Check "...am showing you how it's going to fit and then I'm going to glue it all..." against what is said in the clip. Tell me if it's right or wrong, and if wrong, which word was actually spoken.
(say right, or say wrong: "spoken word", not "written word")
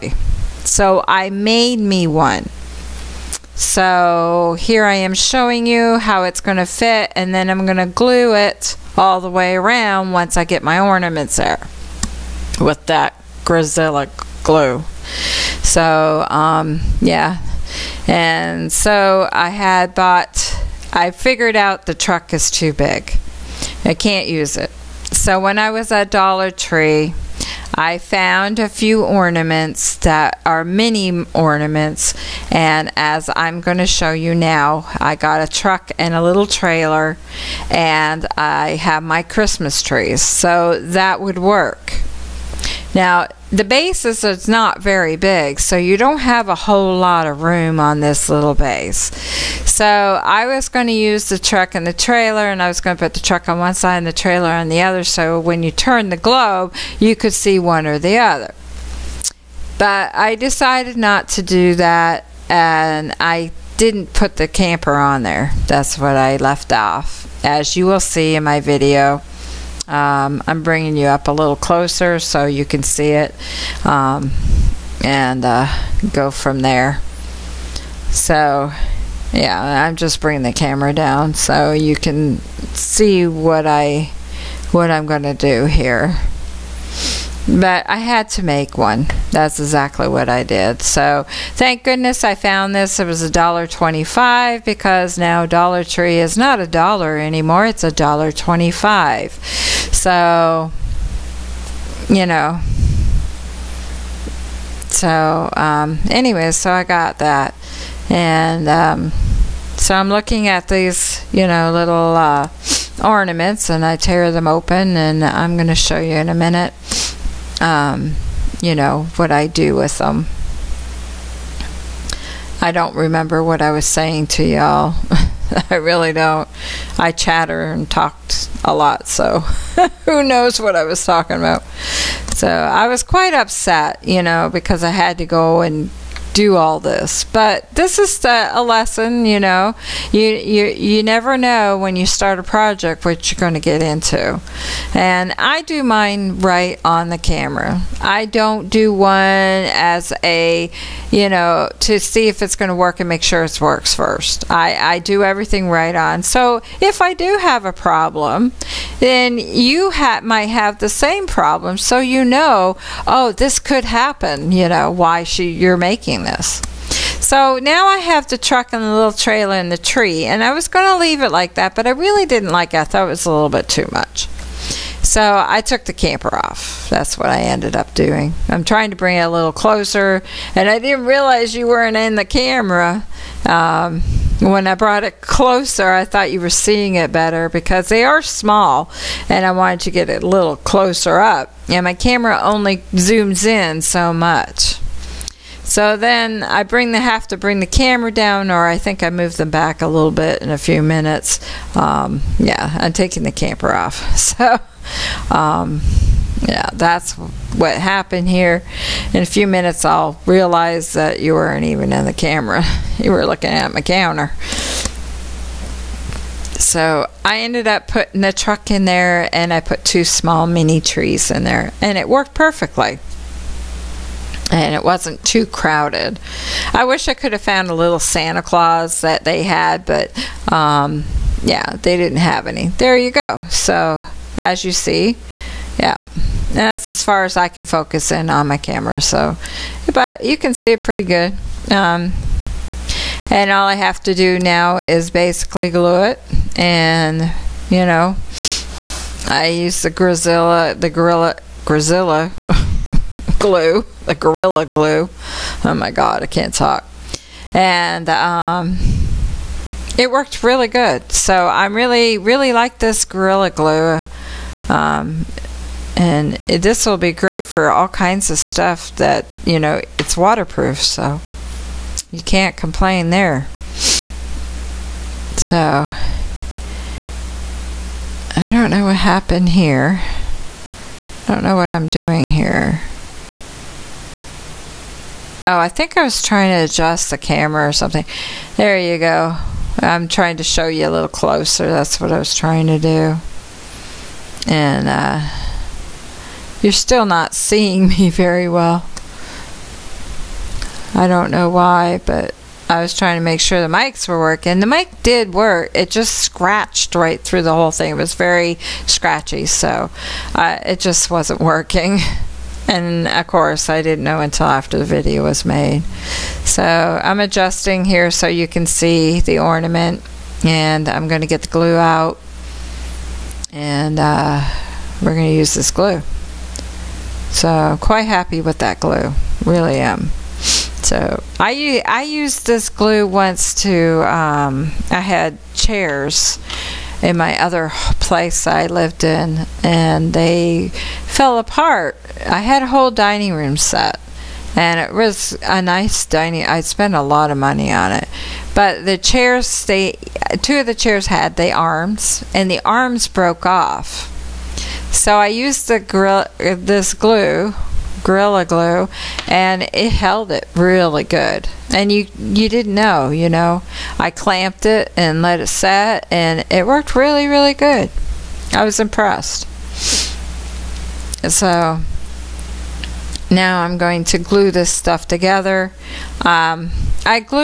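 right.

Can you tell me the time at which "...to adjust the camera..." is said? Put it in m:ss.
4:46.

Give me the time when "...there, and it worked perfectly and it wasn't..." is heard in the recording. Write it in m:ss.
3:41.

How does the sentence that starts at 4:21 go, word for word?
So I'm really, really like this gorilla glue.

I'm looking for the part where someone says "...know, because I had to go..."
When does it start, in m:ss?
2:14.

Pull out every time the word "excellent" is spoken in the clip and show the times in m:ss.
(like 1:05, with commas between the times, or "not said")
not said.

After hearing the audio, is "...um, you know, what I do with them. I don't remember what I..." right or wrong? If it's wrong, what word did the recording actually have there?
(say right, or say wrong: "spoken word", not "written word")
right.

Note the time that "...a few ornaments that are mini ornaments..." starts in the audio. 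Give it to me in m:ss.
0:28.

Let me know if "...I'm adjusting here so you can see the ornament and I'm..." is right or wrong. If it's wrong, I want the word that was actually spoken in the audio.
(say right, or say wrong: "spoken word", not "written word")
right.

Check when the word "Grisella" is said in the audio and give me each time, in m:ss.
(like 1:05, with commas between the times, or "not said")
0:13.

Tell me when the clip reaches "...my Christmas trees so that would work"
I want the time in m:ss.
0:39.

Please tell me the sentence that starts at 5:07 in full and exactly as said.
It was very scratchy, so uh, it just wasn't working.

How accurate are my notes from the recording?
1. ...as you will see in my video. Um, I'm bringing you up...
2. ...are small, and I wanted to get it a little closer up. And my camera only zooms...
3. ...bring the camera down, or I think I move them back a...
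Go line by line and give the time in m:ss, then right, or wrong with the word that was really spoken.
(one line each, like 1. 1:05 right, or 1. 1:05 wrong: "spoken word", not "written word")
1. 1:07 right
2. 3:08 right
3. 3:17 right.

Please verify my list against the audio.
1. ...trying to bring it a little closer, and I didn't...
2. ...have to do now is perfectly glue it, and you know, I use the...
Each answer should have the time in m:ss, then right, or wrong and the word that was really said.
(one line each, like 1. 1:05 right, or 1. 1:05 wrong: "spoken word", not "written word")
1. 2:58 right
2. 4:03 wrong: "basically", not "perfectly".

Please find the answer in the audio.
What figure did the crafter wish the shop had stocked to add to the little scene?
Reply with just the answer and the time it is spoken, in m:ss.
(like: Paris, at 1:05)
Santa Claus, at 3:47.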